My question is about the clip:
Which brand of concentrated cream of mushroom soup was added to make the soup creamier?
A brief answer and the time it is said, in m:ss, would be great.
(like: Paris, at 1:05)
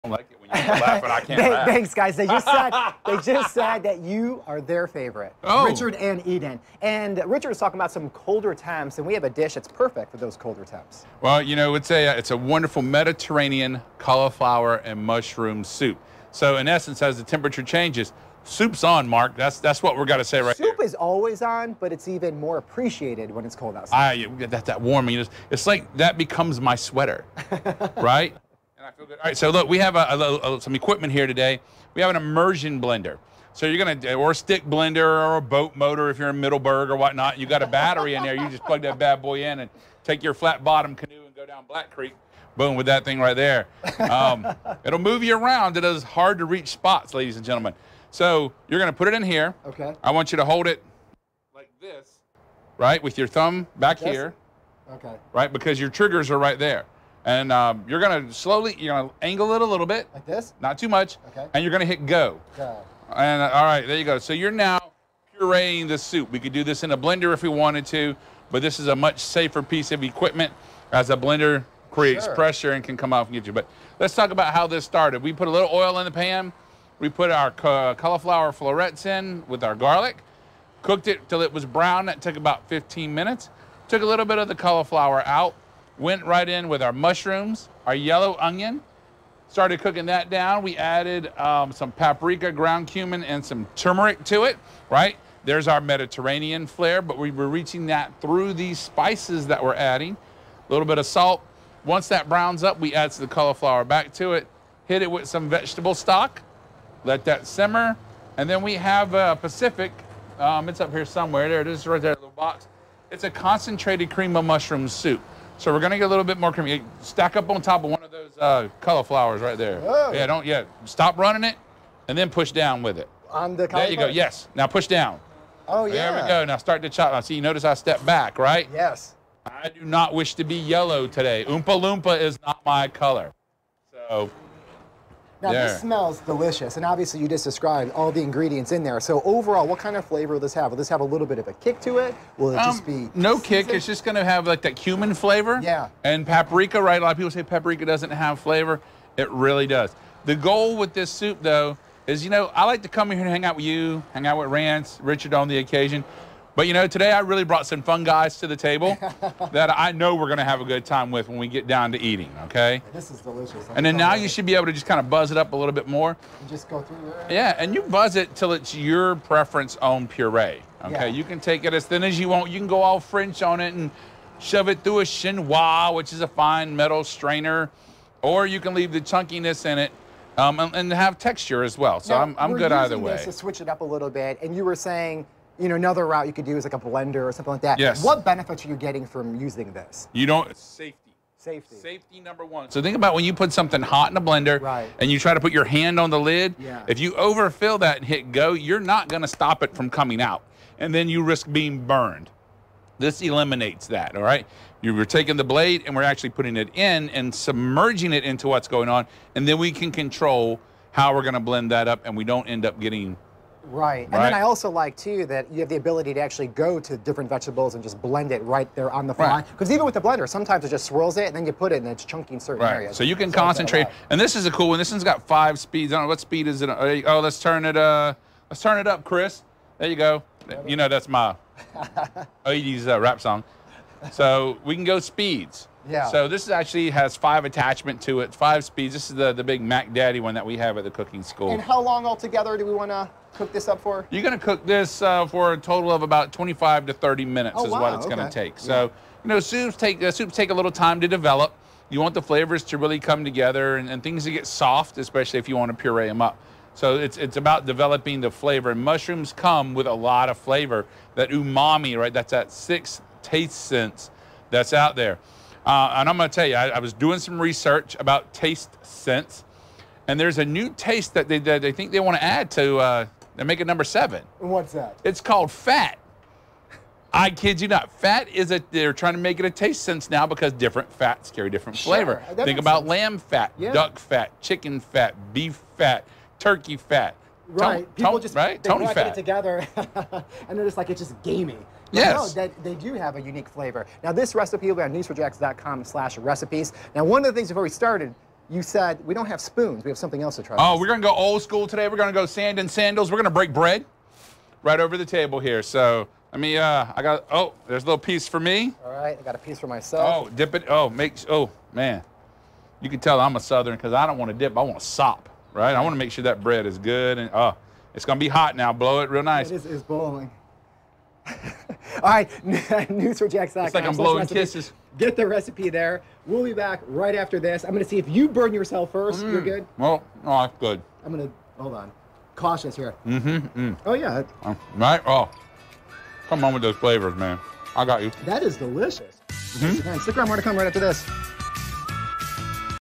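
Pacific, at 1:49.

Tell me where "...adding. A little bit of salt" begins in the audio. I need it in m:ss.
1:39.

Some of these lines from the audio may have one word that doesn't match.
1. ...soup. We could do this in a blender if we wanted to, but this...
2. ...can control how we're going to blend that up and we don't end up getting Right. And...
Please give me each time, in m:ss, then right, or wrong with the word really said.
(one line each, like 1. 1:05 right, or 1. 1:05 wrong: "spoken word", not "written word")
1. 1:05 right
2. 3:29 right.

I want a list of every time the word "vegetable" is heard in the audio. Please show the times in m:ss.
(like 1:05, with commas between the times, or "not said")
1:45, 3:37.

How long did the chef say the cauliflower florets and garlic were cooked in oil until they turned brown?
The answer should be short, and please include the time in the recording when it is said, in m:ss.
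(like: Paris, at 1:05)
15 minutes, at 1:22.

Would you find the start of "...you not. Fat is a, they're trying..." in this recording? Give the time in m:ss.
4:37.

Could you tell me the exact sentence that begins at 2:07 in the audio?
Now, see, you notice I step back, right?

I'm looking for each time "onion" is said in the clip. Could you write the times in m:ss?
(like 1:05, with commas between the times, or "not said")
1:28.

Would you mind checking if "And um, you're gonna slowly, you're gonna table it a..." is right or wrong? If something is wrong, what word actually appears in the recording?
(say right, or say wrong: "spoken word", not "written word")
wrong: "angle", not "table".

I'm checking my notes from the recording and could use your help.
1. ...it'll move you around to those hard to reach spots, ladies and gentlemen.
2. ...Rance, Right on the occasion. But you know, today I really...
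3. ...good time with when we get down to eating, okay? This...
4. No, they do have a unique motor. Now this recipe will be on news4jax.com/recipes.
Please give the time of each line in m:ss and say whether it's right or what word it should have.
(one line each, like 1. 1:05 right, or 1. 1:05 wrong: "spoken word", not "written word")
1. 0:44 right
2. 2:34 wrong: "Richard", not "Right"
3. 2:40 right
4. 4:52 wrong: "flavor", not "motor".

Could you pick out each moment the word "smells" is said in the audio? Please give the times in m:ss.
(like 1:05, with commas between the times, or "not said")
2:15.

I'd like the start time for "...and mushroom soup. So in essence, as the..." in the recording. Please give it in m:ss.
0:14.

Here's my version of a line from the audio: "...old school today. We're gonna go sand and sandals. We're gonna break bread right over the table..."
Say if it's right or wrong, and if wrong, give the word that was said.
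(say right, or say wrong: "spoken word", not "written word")
right.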